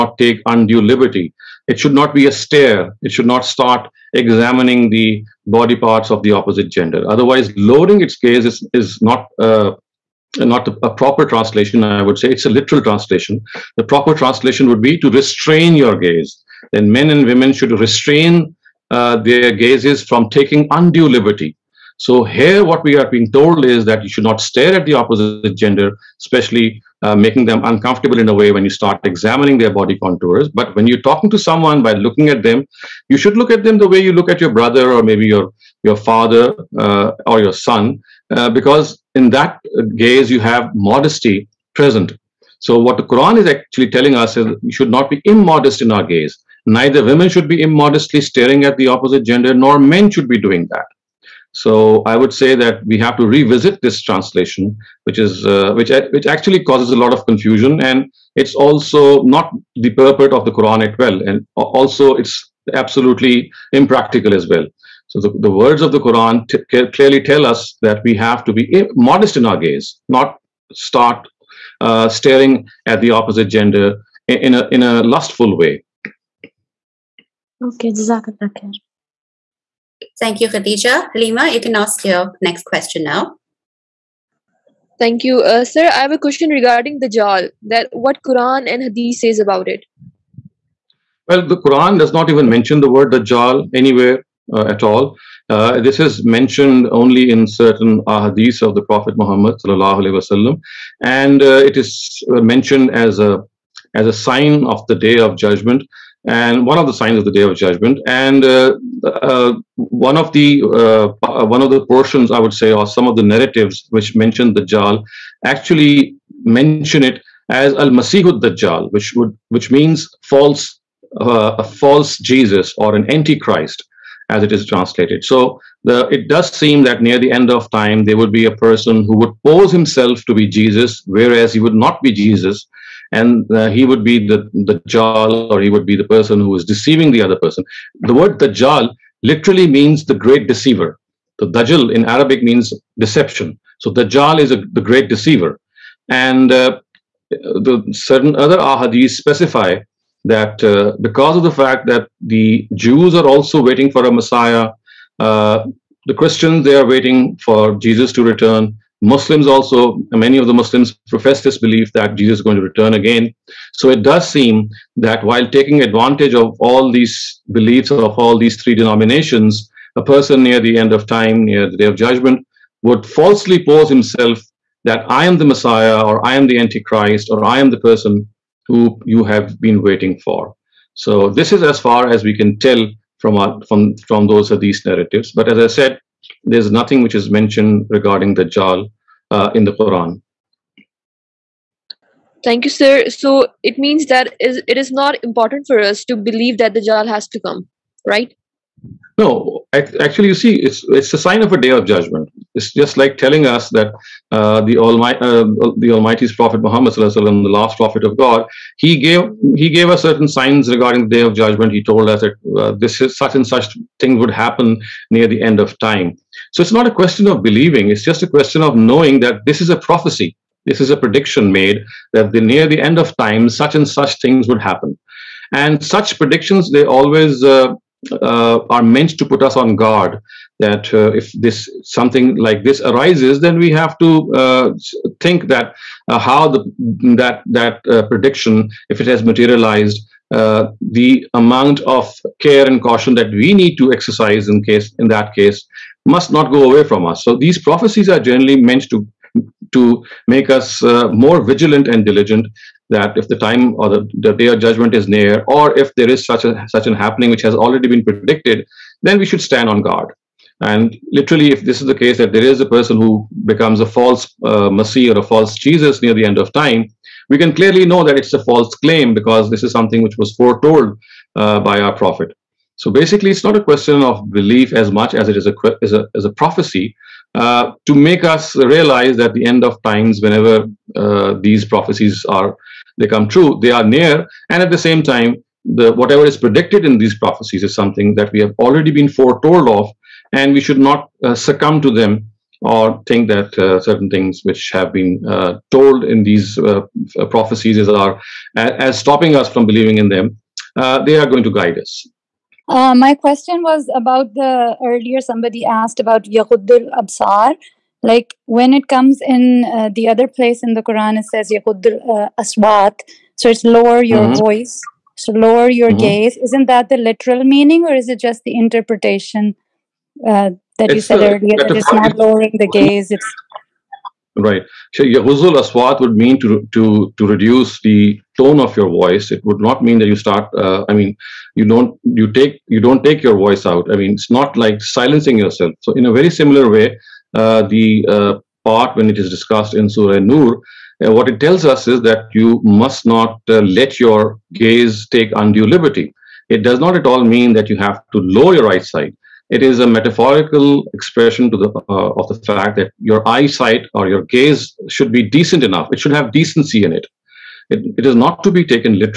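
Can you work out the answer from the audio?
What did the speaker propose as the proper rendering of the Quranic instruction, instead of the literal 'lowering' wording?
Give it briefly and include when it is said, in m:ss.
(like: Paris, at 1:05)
restrain your gaze, at 0:15.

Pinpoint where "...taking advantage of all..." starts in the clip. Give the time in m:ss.
2:45.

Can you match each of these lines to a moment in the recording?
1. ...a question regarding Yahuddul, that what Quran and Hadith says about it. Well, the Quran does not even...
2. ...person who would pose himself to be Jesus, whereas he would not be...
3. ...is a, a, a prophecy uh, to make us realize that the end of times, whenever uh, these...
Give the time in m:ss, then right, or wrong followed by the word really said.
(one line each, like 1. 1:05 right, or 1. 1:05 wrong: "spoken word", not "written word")
1. 1:26 wrong: "Dajjal", not "Yahuddul"
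2. 2:08 right
3. 4:35 right.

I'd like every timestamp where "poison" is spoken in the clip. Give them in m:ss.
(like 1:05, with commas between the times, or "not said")
not said.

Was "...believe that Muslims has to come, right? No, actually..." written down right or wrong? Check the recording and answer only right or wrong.
wrong.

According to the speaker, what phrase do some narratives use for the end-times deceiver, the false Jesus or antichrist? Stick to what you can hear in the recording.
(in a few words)
Al Masihud Dajjal.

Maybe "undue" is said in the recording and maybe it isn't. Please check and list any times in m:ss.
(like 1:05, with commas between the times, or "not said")
0:00, 0:20, 5:45.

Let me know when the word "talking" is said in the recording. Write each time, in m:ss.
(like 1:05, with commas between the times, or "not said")
0:31.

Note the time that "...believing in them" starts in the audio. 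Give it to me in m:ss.
4:59.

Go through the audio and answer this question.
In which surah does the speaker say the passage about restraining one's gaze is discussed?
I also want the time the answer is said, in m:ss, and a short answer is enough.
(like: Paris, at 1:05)
Surah Nur, at 5:39.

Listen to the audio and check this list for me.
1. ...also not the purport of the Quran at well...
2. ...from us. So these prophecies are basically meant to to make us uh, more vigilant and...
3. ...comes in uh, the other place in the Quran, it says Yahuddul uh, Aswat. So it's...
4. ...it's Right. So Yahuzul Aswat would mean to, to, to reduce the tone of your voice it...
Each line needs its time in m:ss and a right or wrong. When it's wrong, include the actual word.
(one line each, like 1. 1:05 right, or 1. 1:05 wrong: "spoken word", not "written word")
1. 0:58 right
2. 4:06 wrong: "generally", not "basically"
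3. 5:08 right
4. 5:23 right.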